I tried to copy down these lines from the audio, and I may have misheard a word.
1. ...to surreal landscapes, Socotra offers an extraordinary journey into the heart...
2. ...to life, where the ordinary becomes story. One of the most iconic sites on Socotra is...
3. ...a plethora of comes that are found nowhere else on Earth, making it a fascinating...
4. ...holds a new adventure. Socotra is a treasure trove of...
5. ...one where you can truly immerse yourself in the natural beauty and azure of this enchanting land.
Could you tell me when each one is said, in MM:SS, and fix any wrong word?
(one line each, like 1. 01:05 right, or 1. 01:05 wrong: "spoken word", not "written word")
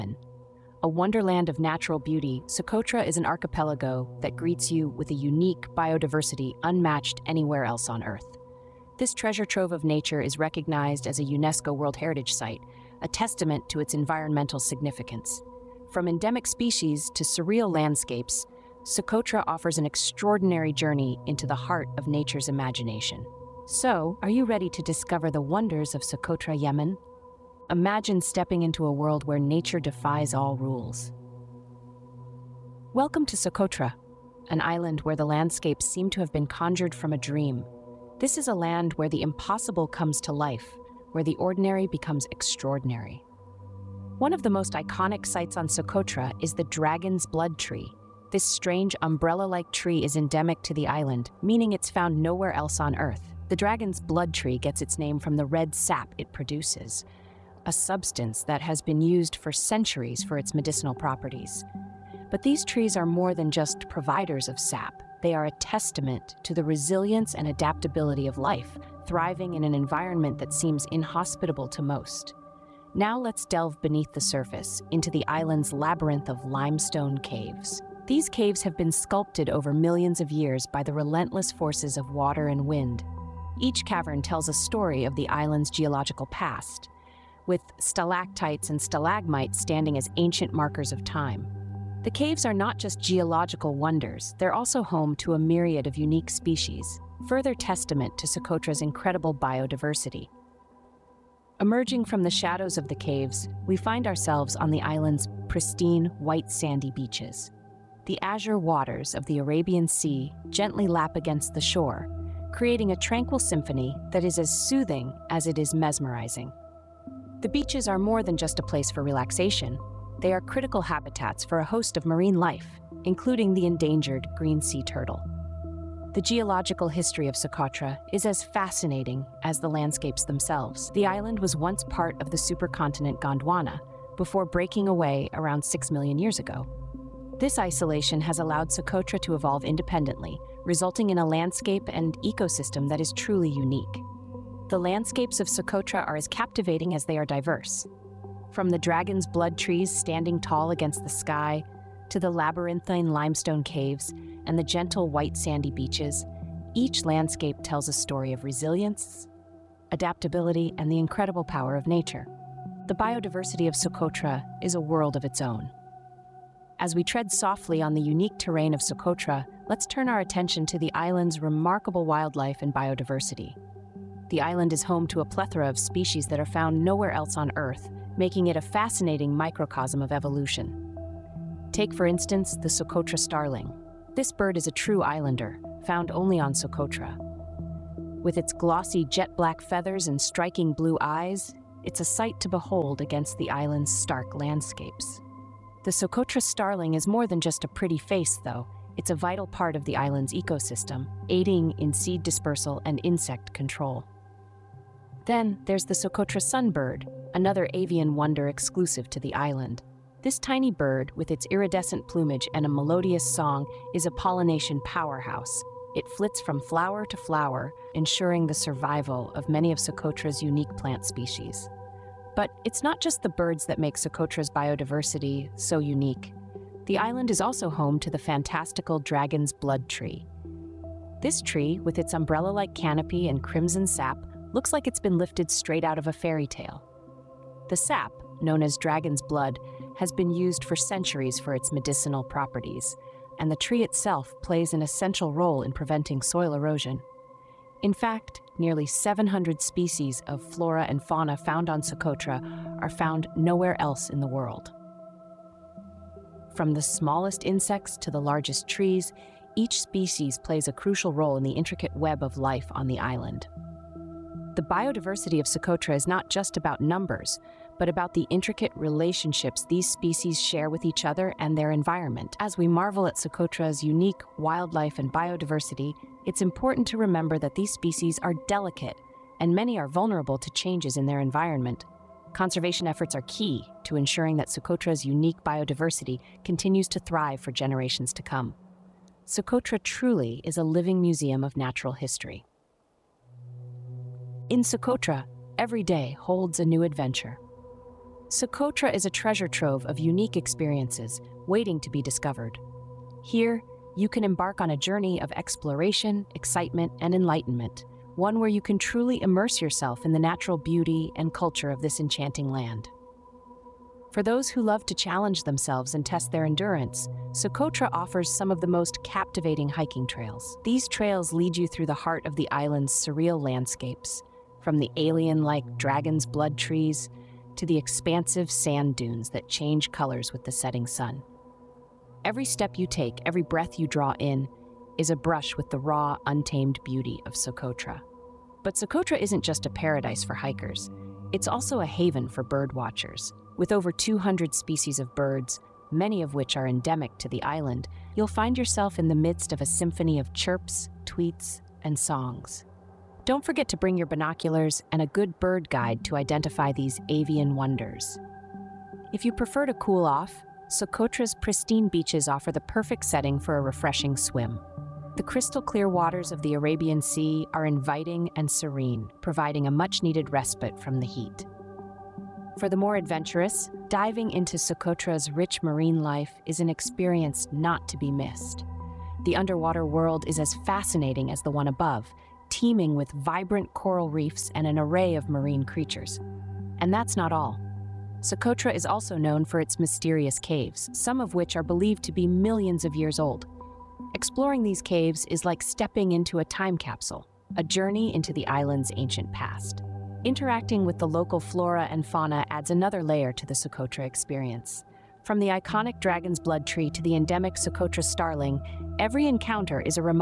1. 00:17 right
2. 00:40 wrong: "extraordinary", not "story"
3. 02:55 wrong: "species", not "comes"
4. 04:56 right
5. 05:08 wrong: "culture", not "azure".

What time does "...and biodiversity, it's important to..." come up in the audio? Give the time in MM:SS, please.
04:34.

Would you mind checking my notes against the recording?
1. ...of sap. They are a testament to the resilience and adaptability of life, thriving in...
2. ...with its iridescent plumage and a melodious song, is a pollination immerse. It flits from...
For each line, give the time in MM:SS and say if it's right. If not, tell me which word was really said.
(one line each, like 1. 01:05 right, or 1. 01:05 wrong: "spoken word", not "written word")
1. 01:04 right
2. 03:31 wrong: "powerhouse", not "immerse".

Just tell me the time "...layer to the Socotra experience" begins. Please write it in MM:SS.
06:43.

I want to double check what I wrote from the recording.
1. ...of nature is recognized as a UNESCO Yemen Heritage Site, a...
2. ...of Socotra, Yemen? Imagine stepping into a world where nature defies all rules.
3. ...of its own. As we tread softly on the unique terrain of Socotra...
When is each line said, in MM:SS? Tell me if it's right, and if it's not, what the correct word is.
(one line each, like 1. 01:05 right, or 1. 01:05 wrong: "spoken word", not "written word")
1. 00:09 wrong: "World", not "Yemen"
2. 00:25 right
3. 02:45 right.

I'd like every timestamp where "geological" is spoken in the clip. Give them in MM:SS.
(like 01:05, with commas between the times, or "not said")
01:25, 01:33, 02:06.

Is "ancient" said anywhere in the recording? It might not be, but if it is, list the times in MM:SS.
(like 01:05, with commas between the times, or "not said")
01:30, 06:38.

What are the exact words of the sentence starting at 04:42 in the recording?
Conservation efforts are key, to ensuring that Socotra's unique biodiversity continues to thrive for generations to come.